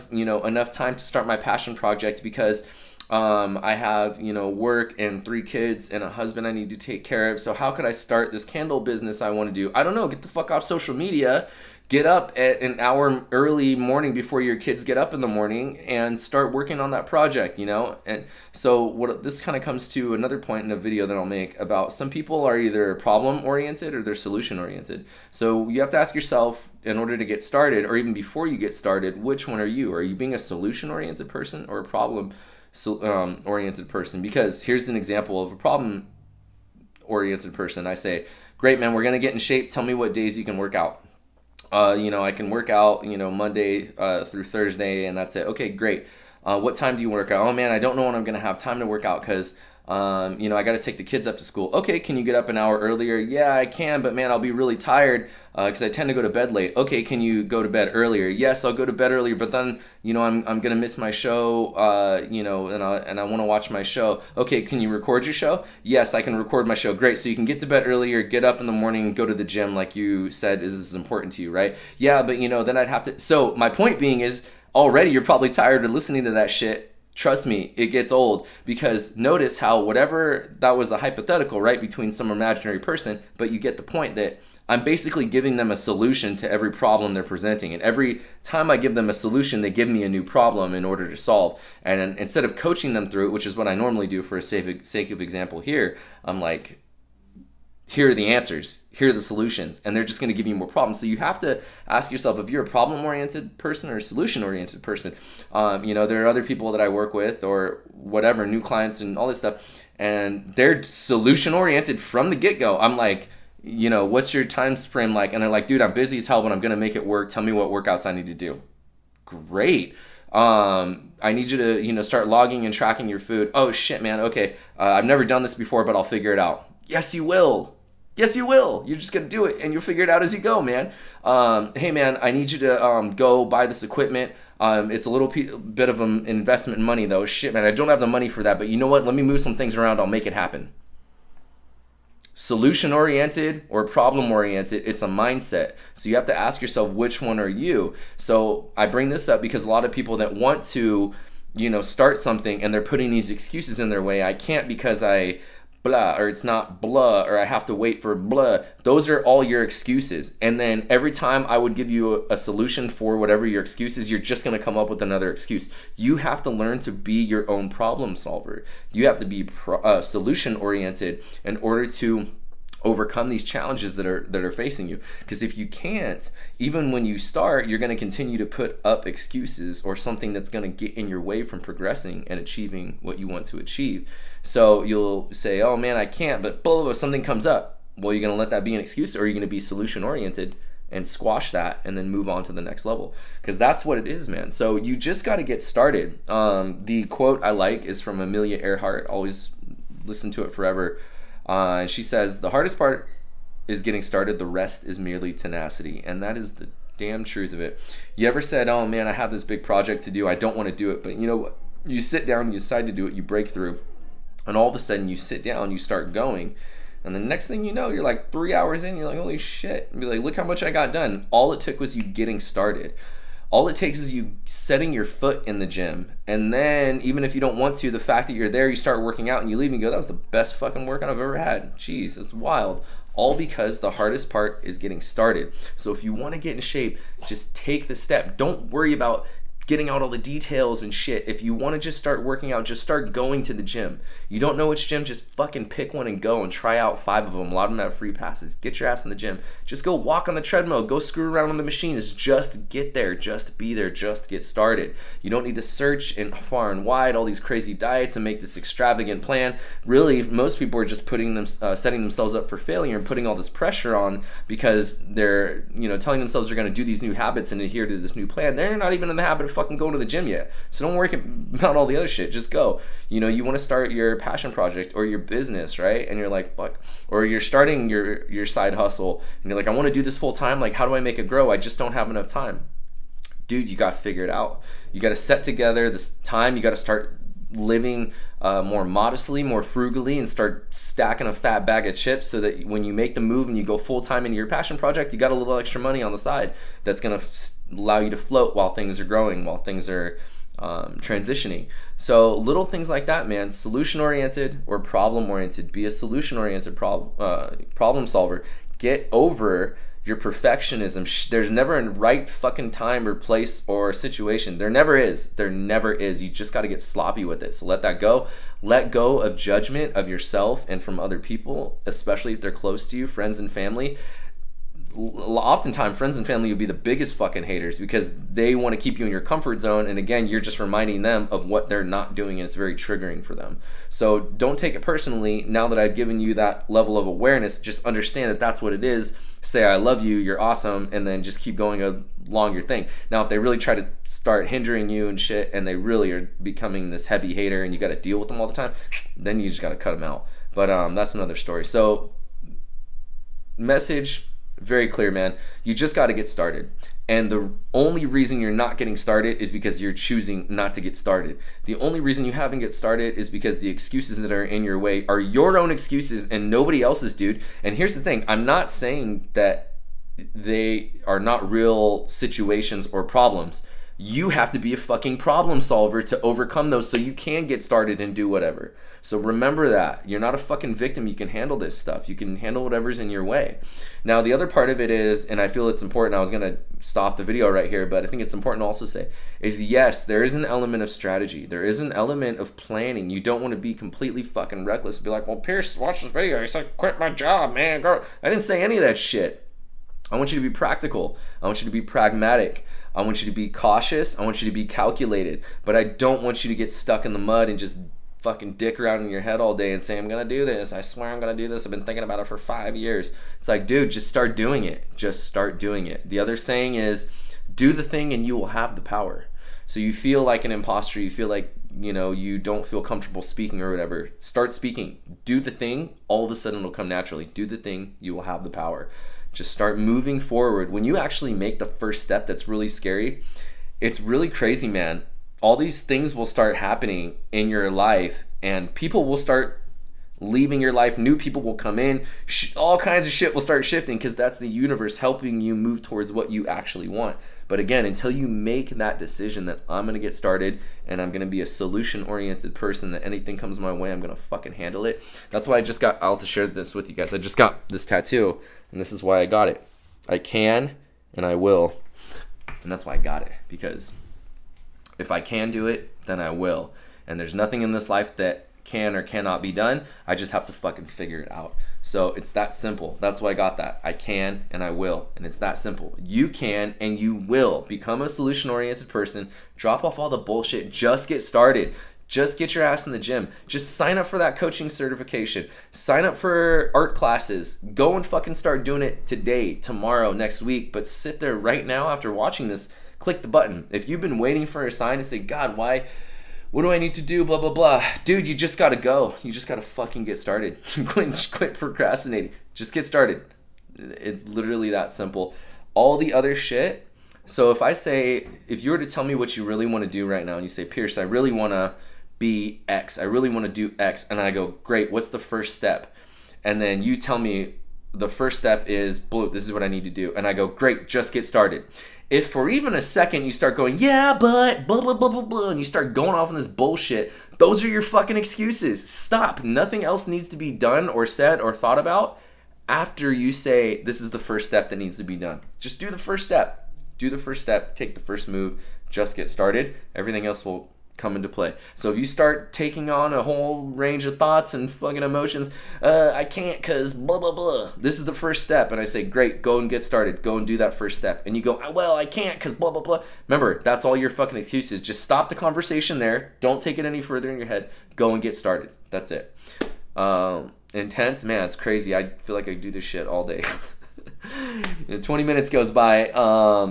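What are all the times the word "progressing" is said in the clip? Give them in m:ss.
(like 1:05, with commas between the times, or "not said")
3:01.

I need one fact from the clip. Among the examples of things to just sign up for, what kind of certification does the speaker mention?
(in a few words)
Coaching certification.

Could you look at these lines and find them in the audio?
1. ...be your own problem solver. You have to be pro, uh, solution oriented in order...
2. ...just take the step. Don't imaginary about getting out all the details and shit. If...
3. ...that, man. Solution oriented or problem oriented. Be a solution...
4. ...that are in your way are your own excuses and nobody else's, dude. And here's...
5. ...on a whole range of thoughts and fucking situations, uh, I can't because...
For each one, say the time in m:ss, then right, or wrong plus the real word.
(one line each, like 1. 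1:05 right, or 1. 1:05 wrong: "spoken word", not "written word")
1. 2:46 right
2. 3:57 wrong: "worry", not "imaginary"
3. 5:03 right
4. 6:04 right
5. 9:02 wrong: "emotions", not "situations".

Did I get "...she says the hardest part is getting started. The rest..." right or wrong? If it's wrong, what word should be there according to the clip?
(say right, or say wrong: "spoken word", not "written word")
right.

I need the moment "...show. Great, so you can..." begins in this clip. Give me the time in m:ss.
1:06.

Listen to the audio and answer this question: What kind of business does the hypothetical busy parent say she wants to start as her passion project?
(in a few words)
Candle business.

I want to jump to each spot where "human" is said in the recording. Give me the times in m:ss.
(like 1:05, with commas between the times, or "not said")
not said.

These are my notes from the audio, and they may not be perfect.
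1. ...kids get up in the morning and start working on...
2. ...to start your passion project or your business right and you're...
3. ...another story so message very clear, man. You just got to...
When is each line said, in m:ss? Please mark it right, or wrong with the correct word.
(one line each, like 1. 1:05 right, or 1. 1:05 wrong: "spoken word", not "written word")
1. 0:14 right
2. 4:33 right
3. 5:51 right.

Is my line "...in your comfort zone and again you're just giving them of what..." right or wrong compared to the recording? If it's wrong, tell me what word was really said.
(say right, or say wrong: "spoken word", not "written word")
wrong: "reminding", not "giving".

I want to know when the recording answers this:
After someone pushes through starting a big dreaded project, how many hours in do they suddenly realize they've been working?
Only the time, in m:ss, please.
3:38.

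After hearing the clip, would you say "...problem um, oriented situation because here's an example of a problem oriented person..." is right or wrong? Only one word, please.
wrong.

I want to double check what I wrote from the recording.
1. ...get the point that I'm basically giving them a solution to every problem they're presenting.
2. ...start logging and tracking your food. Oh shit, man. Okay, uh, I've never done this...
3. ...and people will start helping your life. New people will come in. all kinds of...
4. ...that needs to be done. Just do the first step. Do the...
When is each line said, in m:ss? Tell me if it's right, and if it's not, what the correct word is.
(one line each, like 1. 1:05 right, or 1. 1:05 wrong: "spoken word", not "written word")
1. 1:23 right
2. 2:02 right
3. 7:18 wrong: "leaving", not "helping"
4. 8:54 right.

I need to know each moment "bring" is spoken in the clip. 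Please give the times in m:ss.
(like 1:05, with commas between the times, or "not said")
2:28.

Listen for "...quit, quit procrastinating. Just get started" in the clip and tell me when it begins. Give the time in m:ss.
8:20.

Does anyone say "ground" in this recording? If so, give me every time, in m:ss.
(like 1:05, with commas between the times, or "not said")
not said.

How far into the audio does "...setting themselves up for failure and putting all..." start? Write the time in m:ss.
4:21.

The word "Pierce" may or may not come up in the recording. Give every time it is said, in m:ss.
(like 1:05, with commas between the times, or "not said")
6:35, 8:30.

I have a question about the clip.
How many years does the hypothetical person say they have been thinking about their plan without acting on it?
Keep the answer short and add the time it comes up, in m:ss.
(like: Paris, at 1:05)
5 years, at 6:52.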